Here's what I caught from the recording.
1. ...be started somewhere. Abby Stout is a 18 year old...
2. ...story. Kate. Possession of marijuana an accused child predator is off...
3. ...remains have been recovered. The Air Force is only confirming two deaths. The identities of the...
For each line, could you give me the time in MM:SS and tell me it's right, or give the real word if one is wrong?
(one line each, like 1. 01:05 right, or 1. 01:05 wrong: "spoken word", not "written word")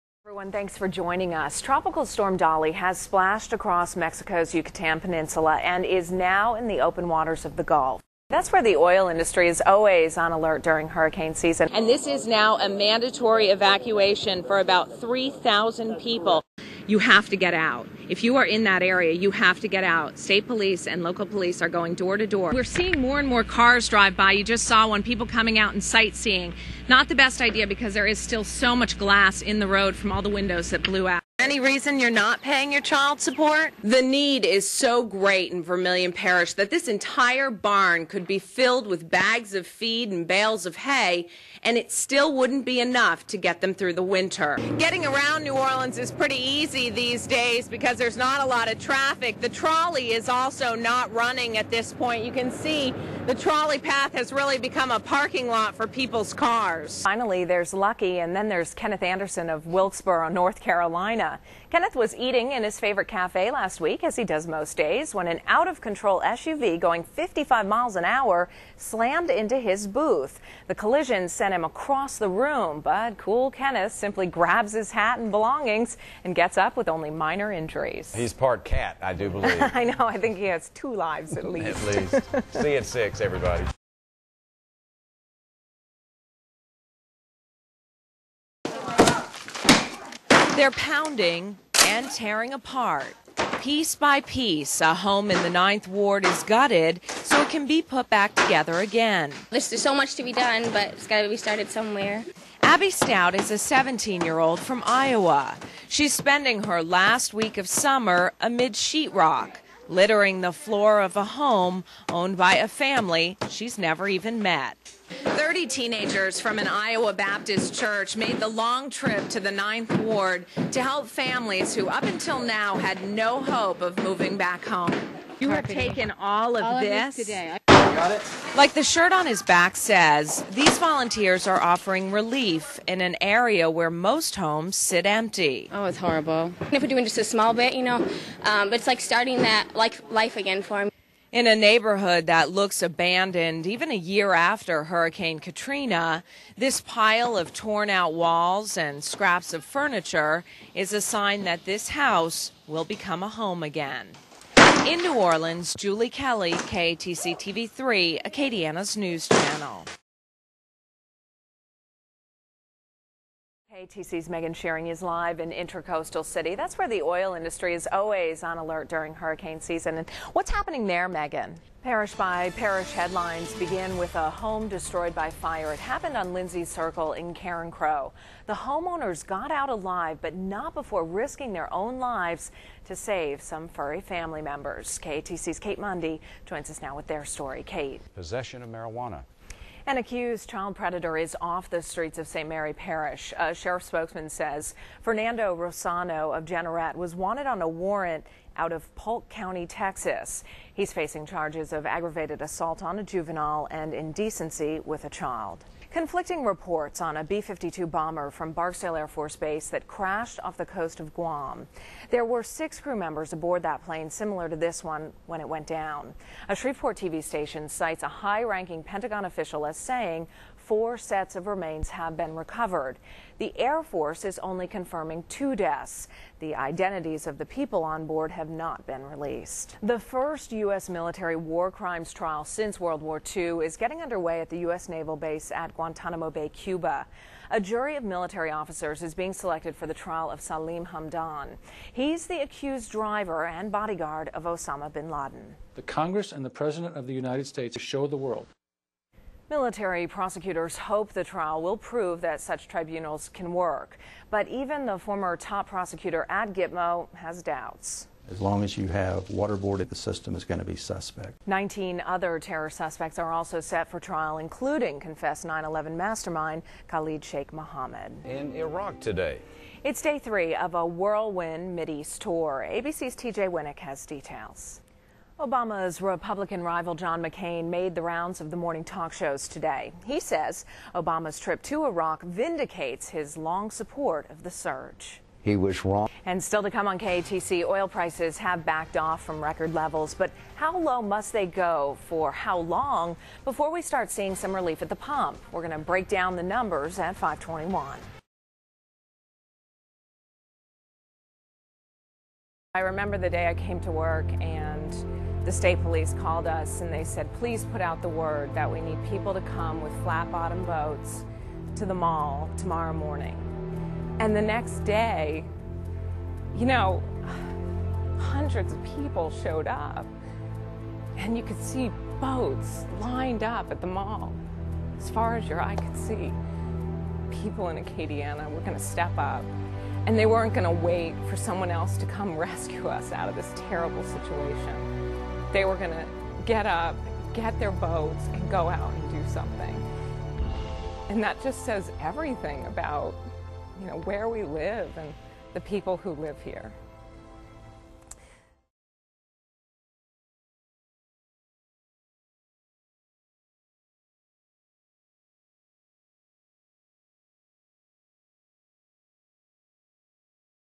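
1. 01:41 wrong: "17", not "18"
2. 03:07 right
3. 03:41 right.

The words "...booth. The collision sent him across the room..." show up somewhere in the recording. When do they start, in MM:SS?
01:09.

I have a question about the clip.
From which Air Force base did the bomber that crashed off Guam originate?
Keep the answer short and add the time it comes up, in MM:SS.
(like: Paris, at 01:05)
Barksdale Air Force Base, at 03:28.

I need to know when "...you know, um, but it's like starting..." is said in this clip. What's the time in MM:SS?
02:17.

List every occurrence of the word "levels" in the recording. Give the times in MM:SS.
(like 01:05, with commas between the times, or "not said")
04:49.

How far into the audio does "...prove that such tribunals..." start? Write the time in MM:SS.
04:11.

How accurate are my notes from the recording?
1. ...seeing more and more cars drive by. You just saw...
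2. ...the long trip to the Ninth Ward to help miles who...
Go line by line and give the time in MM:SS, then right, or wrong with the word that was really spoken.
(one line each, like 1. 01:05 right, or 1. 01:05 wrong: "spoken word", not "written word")
1. 00:22 right
2. 01:58 wrong: "families", not "miles".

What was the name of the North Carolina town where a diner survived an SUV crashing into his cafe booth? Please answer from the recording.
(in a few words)
Wilkesboro.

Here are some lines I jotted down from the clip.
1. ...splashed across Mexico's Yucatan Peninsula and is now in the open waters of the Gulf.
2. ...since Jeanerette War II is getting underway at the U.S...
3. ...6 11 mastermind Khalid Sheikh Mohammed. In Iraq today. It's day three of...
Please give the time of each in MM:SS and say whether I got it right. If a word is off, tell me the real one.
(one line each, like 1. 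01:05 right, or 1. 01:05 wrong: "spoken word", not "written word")
1. 00:02 right
2. 03:52 wrong: "World", not "Jeanerette"
3. 04:25 wrong: "9", not "6".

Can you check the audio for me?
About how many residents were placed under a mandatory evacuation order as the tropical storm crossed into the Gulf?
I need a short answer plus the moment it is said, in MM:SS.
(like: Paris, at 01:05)
3,000, at 00:15.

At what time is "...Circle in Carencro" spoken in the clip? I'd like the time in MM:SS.
02:56.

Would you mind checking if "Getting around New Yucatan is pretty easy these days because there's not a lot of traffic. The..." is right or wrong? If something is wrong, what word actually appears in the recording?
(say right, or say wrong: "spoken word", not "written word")
wrong: "Orleans", not "Yucatan".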